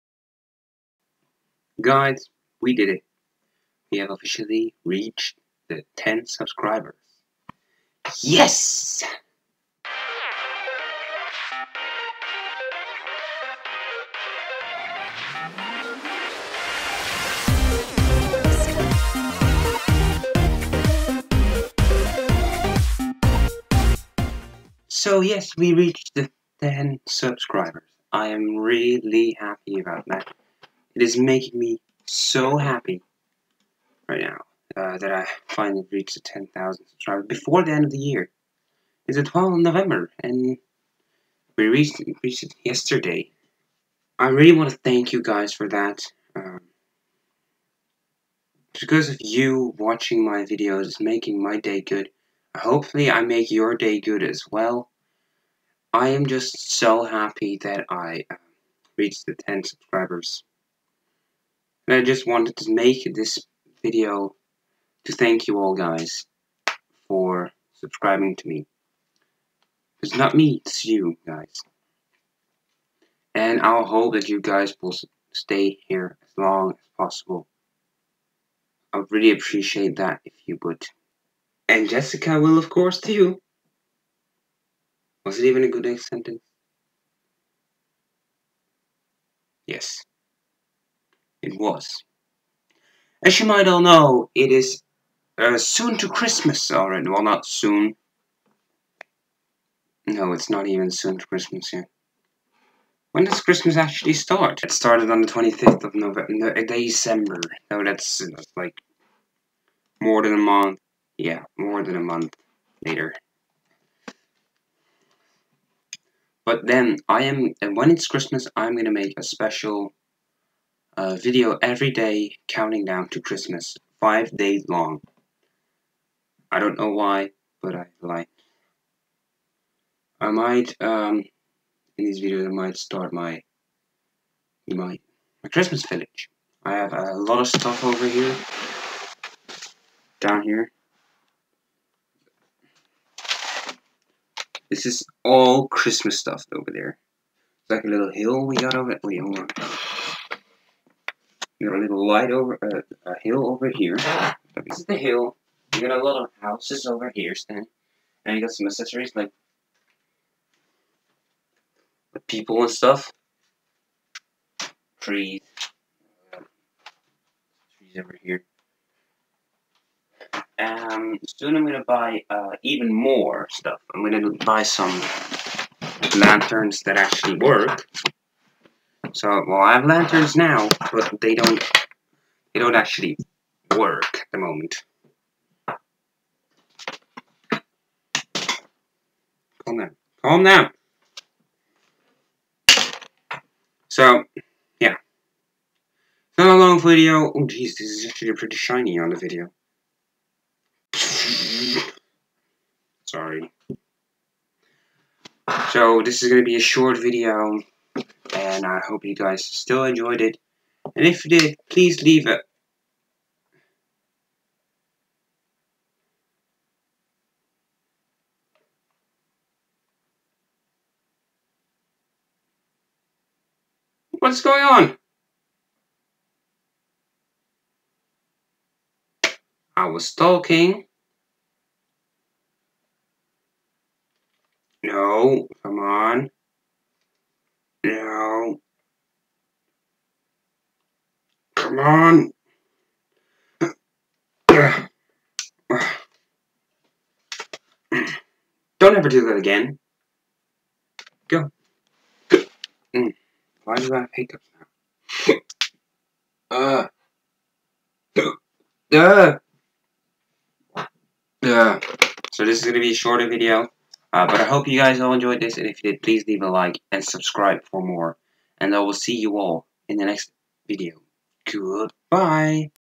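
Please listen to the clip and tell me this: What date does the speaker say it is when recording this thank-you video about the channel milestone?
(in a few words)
12th of November.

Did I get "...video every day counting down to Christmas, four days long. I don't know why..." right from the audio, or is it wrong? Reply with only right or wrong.
wrong.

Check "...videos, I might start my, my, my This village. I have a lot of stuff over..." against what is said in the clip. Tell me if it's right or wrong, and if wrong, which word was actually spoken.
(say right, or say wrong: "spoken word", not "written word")
wrong: "Christmas", not "This".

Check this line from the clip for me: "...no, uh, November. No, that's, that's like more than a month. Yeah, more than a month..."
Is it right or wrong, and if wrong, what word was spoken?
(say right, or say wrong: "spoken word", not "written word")
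wrong: "December", not "November".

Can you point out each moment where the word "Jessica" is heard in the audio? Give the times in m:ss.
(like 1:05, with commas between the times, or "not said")
1:21.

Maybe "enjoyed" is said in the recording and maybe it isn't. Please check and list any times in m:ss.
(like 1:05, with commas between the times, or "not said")
3:29, 4:25.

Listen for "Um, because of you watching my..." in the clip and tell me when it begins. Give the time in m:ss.
0:46.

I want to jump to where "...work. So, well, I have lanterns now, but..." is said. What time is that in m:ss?
2:57.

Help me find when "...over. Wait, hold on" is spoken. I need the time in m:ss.
2:28.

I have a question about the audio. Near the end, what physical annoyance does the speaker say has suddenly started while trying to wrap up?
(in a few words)
hiccups.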